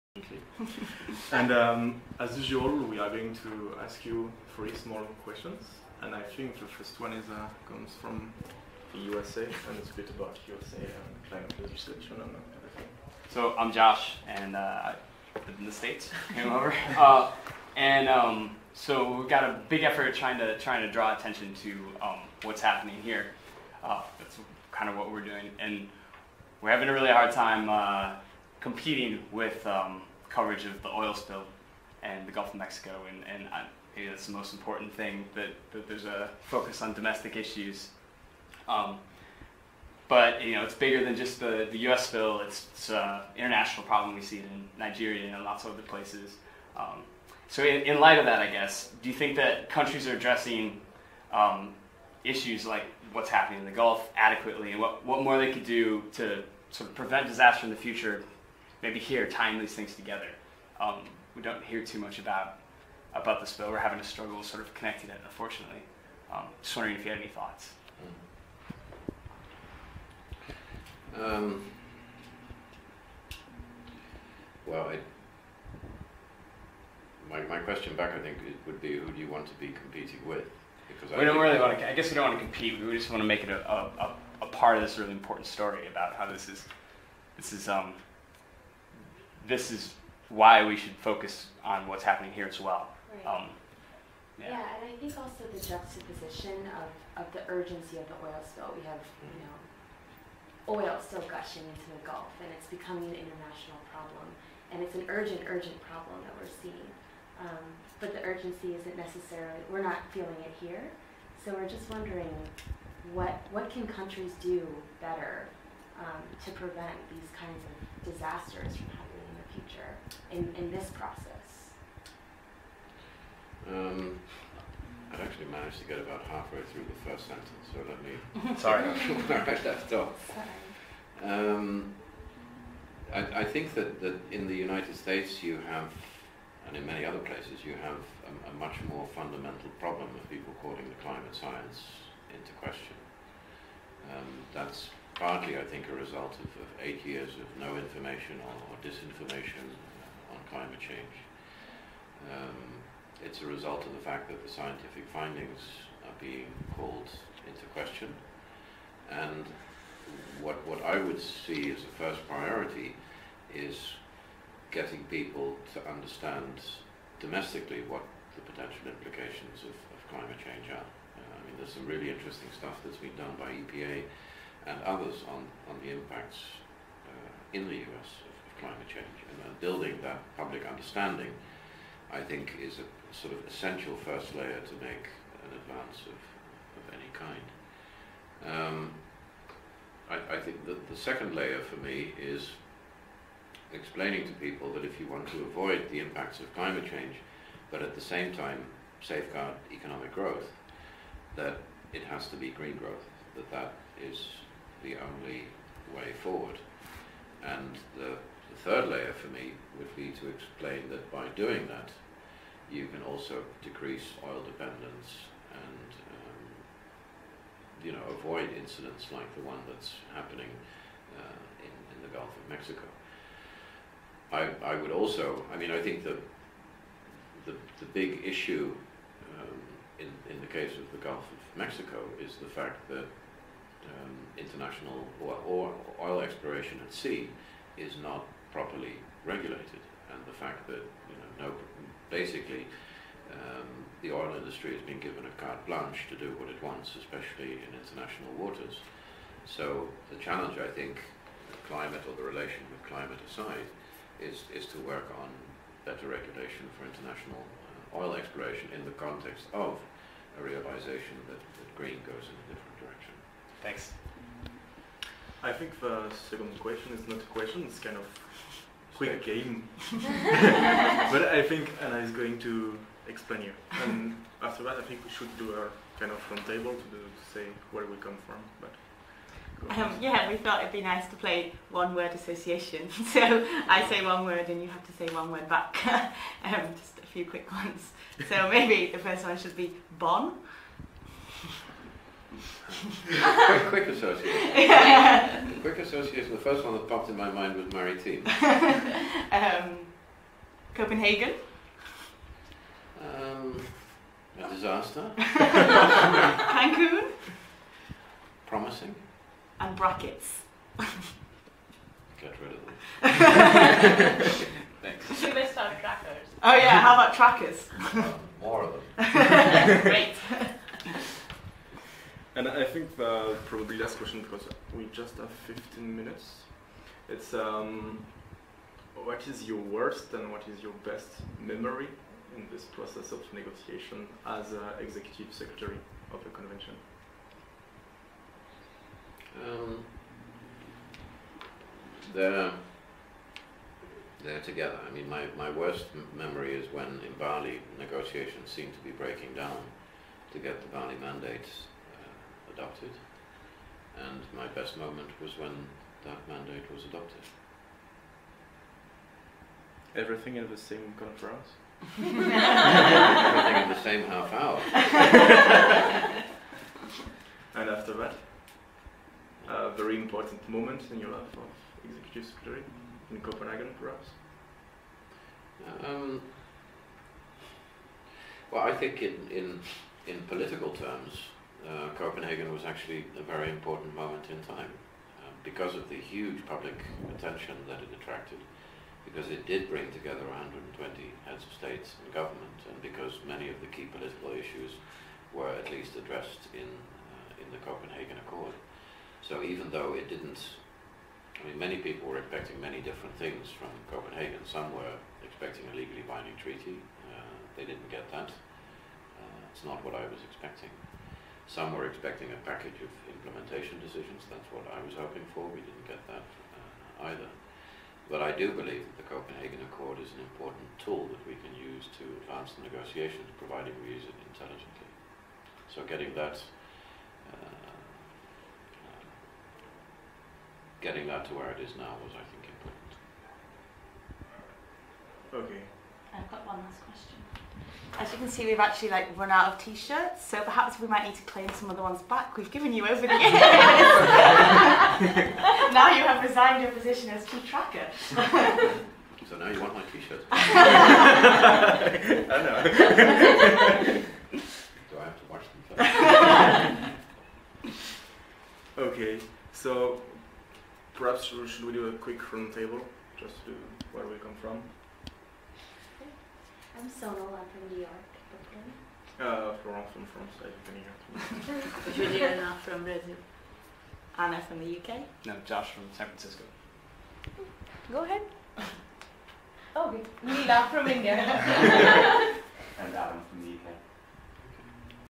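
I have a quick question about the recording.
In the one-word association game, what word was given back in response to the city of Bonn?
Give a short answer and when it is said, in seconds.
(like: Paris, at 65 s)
Maritime, at 297 s.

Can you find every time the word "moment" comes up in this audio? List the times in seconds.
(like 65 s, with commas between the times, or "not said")
354 s, 370 s, 383 s.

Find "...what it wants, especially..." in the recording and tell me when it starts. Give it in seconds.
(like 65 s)
246 s.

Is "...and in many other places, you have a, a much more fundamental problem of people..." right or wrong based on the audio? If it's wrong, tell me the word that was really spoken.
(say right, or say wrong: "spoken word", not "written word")
right.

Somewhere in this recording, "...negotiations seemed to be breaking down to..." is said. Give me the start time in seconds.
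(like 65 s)
347 s.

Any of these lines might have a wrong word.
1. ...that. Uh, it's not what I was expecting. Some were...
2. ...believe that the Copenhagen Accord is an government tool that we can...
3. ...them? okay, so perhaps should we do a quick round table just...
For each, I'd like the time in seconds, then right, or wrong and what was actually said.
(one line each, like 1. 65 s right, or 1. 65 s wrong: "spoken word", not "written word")
1. 408 s right
2. 418 s wrong: "important", not "government"
3. 455 s right.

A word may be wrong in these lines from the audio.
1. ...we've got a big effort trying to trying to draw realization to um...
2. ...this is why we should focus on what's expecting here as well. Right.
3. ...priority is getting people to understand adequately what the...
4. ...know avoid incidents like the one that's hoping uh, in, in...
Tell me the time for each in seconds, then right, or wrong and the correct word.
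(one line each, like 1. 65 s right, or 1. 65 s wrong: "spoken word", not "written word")
1. 19 s wrong: "attention", not "realization"
2. 89 s wrong: "happening", not "expecting"
3. 162 s wrong: "domestically", not "adequately"
4. 217 s wrong: "happening", not "hoping".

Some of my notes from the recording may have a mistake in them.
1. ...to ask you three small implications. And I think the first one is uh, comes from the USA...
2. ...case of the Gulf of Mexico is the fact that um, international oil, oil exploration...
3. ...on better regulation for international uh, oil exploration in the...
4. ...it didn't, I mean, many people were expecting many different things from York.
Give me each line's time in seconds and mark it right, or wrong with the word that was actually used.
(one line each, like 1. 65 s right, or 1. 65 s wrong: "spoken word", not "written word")
1. 3 s wrong: "questions", not "implications"
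2. 230 s right
3. 255 s right
4. 399 s wrong: "Copenhagen", not "York".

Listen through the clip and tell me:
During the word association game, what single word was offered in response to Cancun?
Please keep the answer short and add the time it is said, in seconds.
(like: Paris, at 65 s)
Promising, at 308 s.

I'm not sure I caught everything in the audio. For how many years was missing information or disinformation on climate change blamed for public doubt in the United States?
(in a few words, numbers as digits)
8.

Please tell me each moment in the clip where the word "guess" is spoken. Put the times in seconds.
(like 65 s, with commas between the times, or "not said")
48 s, 81 s.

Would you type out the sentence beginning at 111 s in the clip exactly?
So we're just wondering what, what can countries do better um, to prevent these kinds of disasters from happening?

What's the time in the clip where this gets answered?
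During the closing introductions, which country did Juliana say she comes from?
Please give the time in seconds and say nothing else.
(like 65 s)
472 s.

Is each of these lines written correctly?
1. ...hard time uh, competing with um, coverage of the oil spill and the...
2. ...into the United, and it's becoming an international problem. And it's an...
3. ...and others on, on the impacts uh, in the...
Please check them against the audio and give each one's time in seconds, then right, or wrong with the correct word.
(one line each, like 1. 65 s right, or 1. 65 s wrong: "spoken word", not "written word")
1. 27 s right
2. 101 s wrong: "Gulf", not "United"
3. 174 s right.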